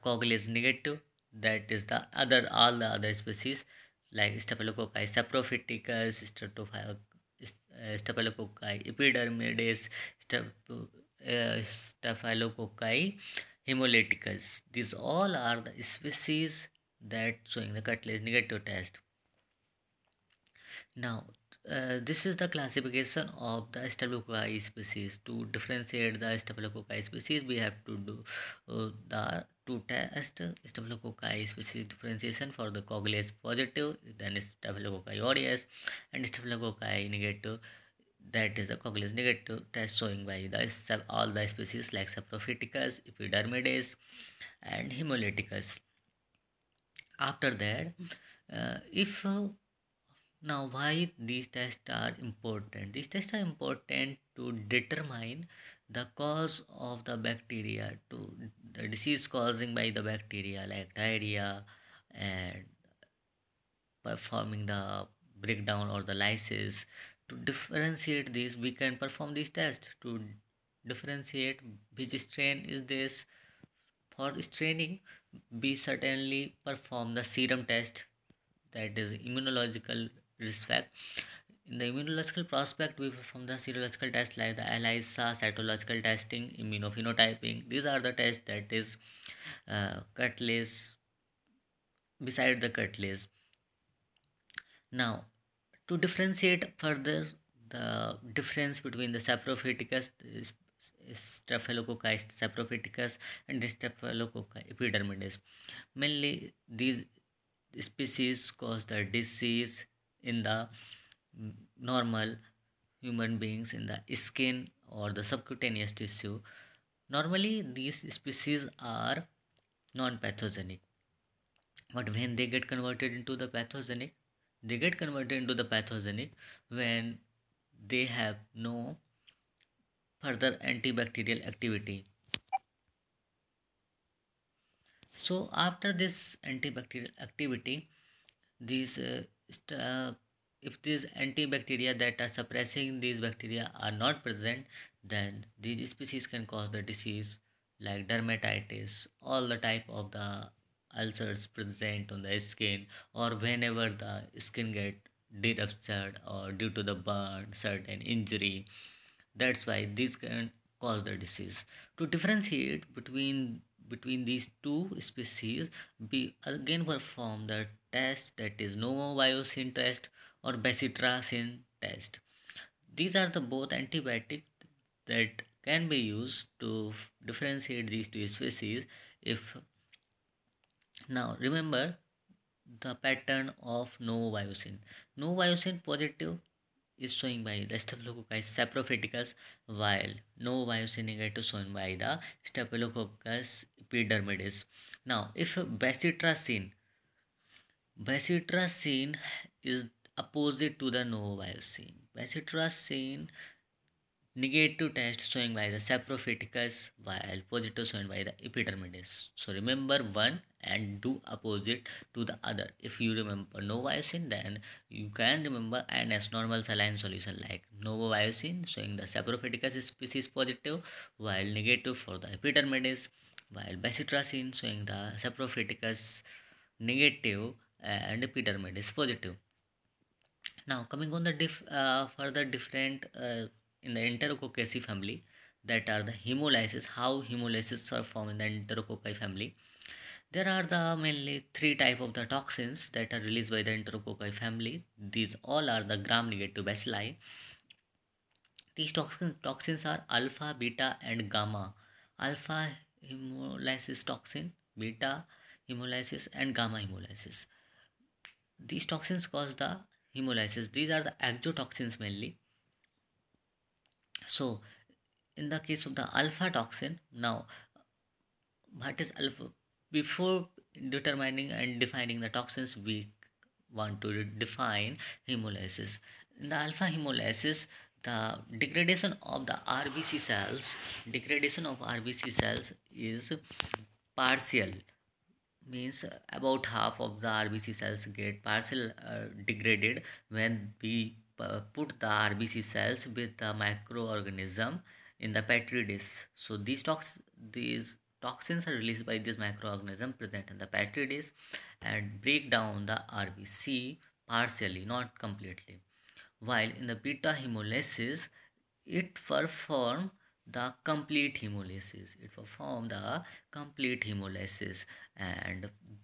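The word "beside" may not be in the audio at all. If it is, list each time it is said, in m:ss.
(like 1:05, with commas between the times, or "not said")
1:32.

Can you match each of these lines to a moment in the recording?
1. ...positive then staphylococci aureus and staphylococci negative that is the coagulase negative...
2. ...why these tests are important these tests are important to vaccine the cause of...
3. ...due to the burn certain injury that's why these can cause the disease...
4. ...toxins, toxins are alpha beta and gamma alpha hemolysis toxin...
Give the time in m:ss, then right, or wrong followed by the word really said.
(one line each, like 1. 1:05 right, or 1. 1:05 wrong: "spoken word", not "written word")
1. 0:33 right
2. 0:50 wrong: "determine", not "vaccine"
3. 2:36 right
4. 4:08 right.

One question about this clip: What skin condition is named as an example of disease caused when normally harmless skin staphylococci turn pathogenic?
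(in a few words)
dermatitis.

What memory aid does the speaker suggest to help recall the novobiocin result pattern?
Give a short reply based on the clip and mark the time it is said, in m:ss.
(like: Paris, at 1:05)
normal saline solution, at 3:36.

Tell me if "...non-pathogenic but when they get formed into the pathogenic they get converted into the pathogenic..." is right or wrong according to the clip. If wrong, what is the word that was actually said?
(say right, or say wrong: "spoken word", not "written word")
wrong: "converted", not "formed".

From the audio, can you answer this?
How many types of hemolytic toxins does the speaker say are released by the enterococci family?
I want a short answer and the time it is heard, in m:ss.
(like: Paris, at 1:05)
3, at 4:01.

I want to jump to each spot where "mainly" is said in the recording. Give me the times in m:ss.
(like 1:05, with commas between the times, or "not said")
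1:45, 4:01, 4:22.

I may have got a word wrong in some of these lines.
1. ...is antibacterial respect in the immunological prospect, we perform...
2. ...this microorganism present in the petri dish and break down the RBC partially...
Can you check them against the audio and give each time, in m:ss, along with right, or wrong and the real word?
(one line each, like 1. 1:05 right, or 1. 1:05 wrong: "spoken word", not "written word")
1. 1:18 wrong: "immunological", not "antibacterial"
2. 4:59 right.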